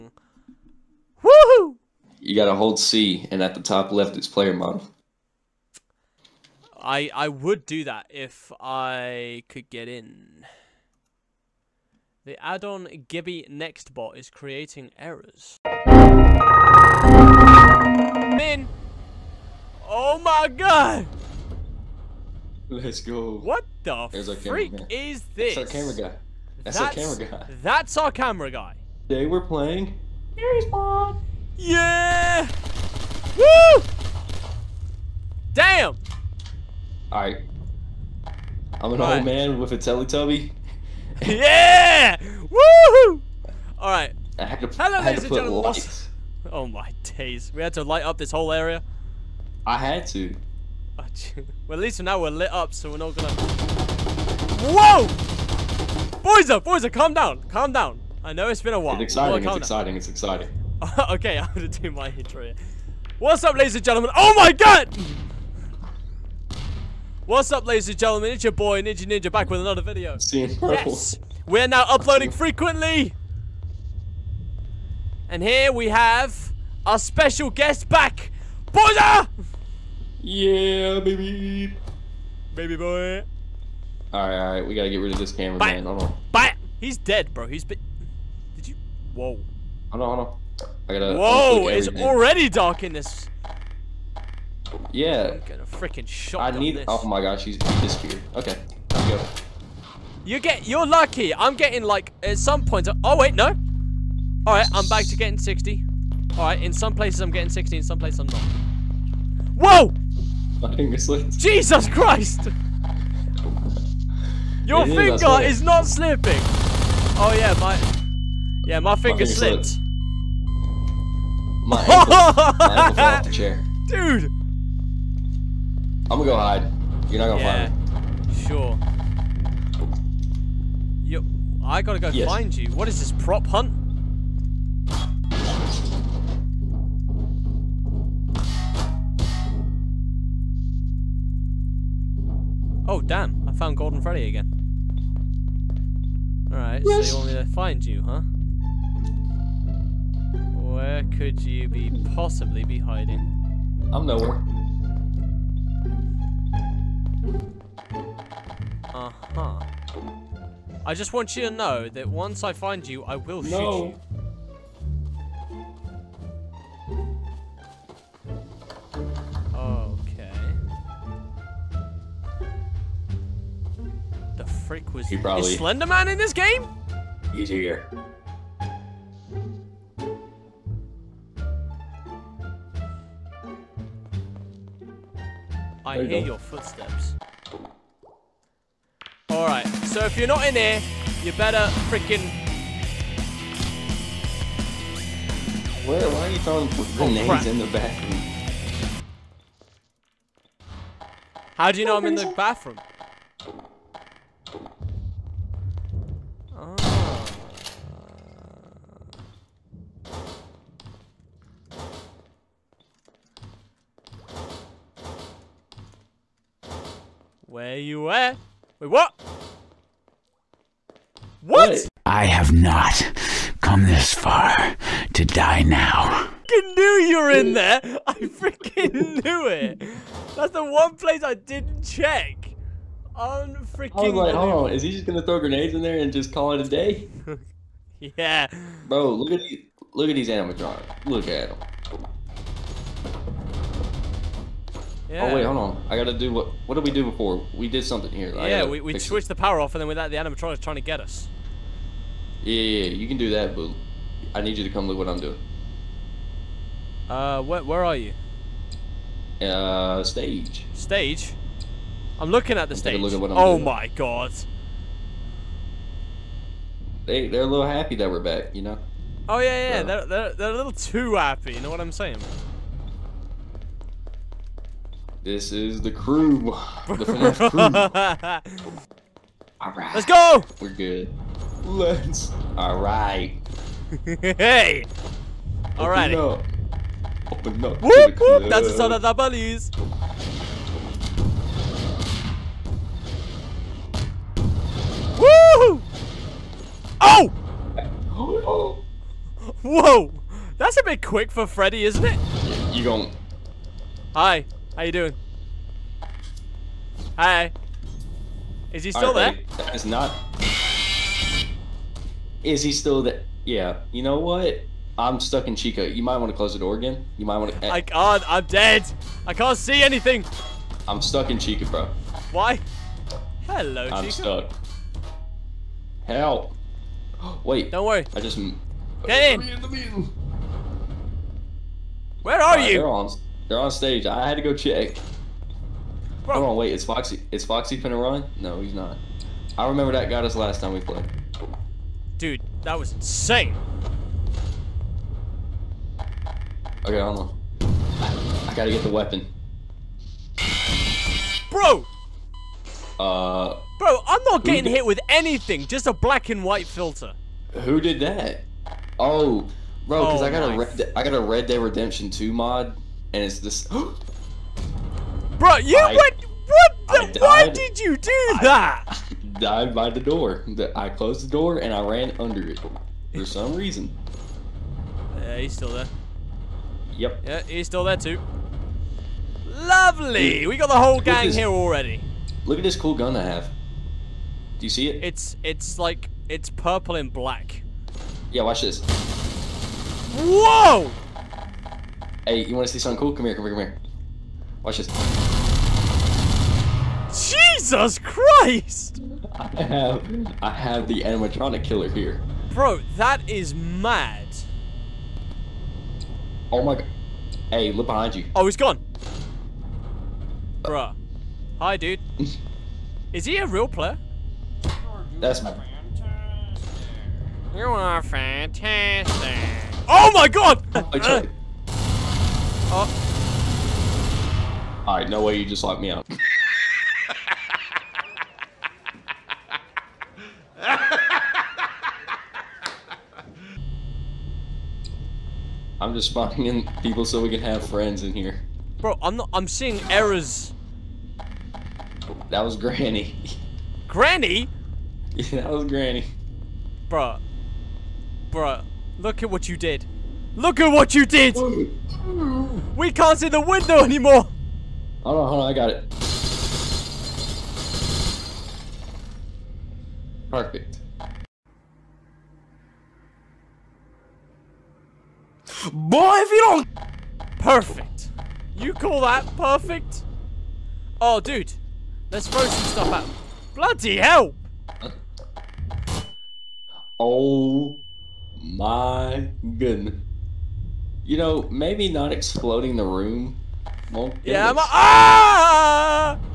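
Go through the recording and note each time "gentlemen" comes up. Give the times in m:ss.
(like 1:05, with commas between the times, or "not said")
1:03, 1:07.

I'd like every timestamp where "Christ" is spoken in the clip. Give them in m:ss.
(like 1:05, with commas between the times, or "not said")
1:51, 6:37.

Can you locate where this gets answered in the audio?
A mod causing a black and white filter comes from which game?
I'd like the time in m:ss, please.
6:01.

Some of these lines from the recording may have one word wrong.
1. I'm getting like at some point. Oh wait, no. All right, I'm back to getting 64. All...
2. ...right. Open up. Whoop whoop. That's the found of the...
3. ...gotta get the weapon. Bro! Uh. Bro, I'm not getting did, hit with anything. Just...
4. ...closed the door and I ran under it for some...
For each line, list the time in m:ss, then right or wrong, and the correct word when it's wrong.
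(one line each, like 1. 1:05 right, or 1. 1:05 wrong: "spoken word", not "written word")
1. 1:41 wrong: "60", not "64"
2. 4:45 wrong: "sound", not "found"
3. 5:48 right
4. 6:10 right.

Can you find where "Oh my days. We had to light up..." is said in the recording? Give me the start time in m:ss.
0:46.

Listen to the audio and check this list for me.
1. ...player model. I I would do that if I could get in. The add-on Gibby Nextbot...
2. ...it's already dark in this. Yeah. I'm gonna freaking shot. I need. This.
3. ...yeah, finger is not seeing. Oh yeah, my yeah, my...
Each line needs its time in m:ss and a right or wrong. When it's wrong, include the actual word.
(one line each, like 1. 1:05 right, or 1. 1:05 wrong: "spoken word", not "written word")
1. 0:04 right
2. 1:31 right
3. 1:54 wrong: "slipping", not "seeing".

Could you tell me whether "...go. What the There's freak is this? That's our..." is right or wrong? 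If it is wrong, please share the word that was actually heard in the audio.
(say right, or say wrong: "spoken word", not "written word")
right.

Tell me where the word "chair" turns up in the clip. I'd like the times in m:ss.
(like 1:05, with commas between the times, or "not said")
2:03.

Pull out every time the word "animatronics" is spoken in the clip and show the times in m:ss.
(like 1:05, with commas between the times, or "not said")
4:00, 4:10, 6:41.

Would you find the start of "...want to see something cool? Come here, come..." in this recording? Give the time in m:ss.
6:32.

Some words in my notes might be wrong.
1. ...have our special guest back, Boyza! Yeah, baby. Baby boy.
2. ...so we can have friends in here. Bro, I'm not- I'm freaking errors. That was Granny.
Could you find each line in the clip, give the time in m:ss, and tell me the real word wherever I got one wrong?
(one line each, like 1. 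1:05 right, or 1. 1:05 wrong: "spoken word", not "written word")
1. 1:15 right
2. 7:17 wrong: "seeing", not "freaking".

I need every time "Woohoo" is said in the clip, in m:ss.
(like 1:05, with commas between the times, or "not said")
0:01, 0:42.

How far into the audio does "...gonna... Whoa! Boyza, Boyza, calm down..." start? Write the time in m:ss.
0:53.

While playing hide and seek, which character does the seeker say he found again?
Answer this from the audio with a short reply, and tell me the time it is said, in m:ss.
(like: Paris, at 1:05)
Golden Freddy, at 2:23.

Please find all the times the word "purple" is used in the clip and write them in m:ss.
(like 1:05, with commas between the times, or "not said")
1:10, 6:26.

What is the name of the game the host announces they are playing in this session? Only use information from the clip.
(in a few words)
Here's Bob.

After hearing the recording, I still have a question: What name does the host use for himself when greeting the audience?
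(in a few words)
Ninji Ninja.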